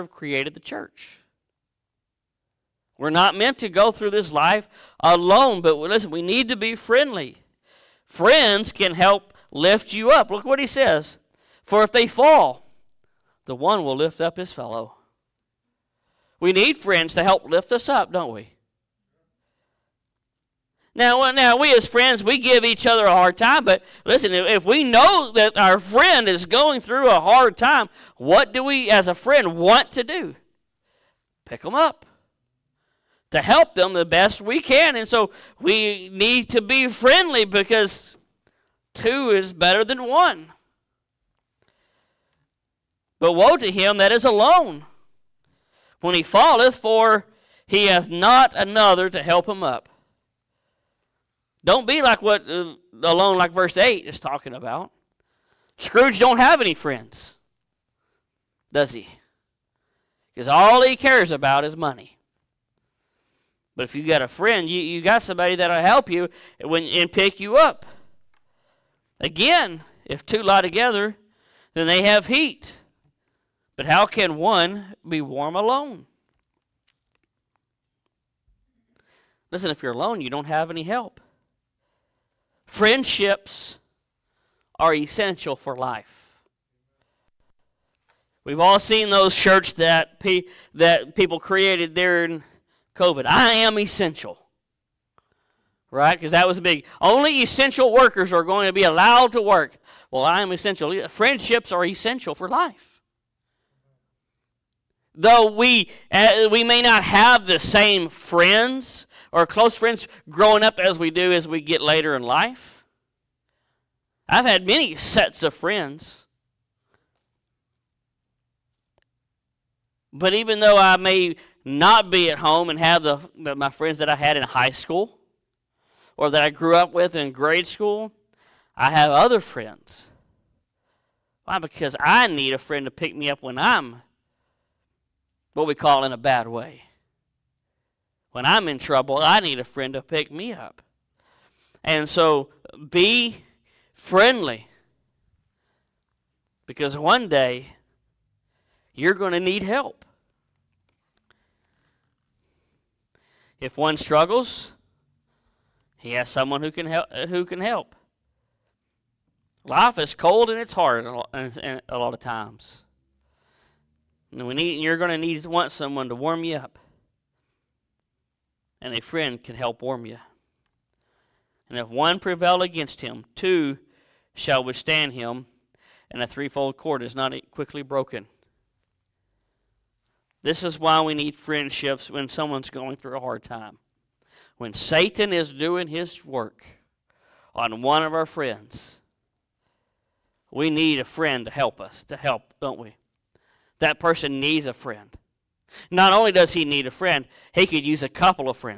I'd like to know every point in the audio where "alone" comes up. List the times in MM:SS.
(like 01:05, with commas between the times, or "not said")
00:04, 00:44, 00:53, 01:15, 01:19.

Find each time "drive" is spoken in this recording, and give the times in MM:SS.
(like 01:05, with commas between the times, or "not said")
not said.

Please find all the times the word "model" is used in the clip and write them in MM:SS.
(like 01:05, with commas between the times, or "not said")
not said.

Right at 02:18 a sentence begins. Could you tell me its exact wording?
When I'm in trouble, I need a friend to pick me up.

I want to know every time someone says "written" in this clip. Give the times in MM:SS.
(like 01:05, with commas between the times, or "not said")
not said.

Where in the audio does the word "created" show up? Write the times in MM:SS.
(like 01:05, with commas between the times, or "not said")
00:00, 01:31.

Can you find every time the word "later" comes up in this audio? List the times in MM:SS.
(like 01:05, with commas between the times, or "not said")
01:51.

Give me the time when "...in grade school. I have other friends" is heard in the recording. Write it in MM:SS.
02:07.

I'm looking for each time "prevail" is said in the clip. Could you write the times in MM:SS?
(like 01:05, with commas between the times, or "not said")
02:52.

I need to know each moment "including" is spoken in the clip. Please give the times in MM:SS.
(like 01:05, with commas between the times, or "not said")
not said.